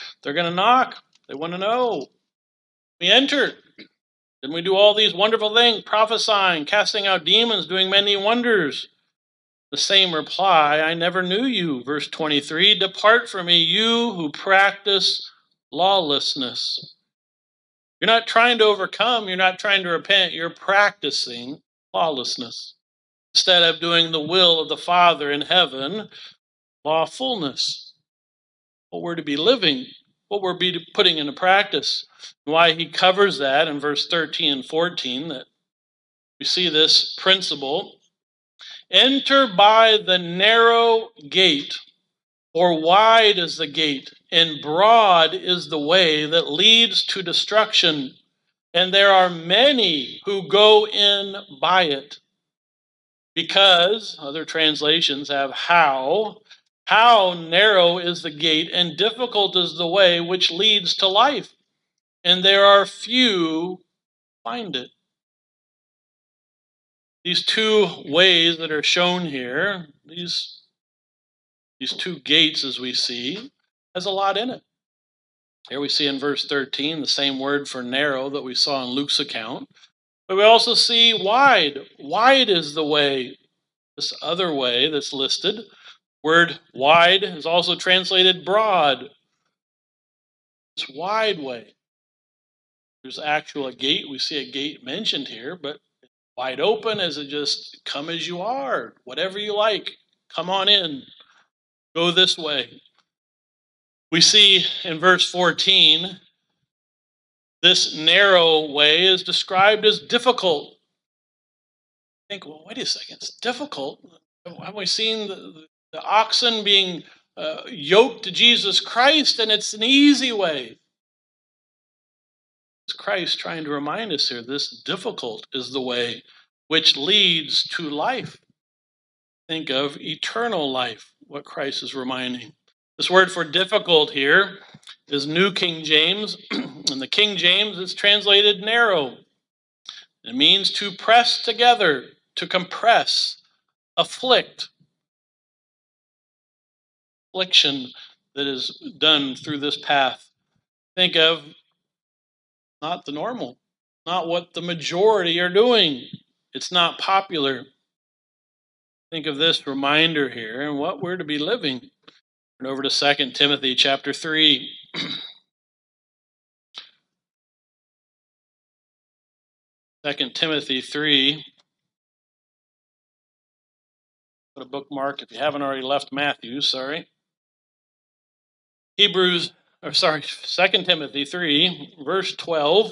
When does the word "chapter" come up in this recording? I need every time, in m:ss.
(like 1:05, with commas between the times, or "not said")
2:43.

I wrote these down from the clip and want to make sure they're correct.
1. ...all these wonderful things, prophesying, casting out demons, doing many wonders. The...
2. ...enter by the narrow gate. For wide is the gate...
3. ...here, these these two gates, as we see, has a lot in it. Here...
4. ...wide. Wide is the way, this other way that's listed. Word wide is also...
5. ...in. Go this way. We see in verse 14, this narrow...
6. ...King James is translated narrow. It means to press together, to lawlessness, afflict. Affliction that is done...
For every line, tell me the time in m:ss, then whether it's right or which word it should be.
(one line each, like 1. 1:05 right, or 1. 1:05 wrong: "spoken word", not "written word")
1. 0:04 right
2. 0:38 right
3. 1:09 right
4. 1:21 right
5. 1:40 right
6. 2:17 wrong: "compress", not "lawlessness".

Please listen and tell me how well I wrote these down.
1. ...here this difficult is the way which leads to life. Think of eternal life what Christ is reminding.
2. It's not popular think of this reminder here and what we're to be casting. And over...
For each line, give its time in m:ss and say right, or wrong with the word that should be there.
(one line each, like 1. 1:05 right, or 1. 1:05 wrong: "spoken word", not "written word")
1. 2:04 right
2. 2:36 wrong: "living", not "casting".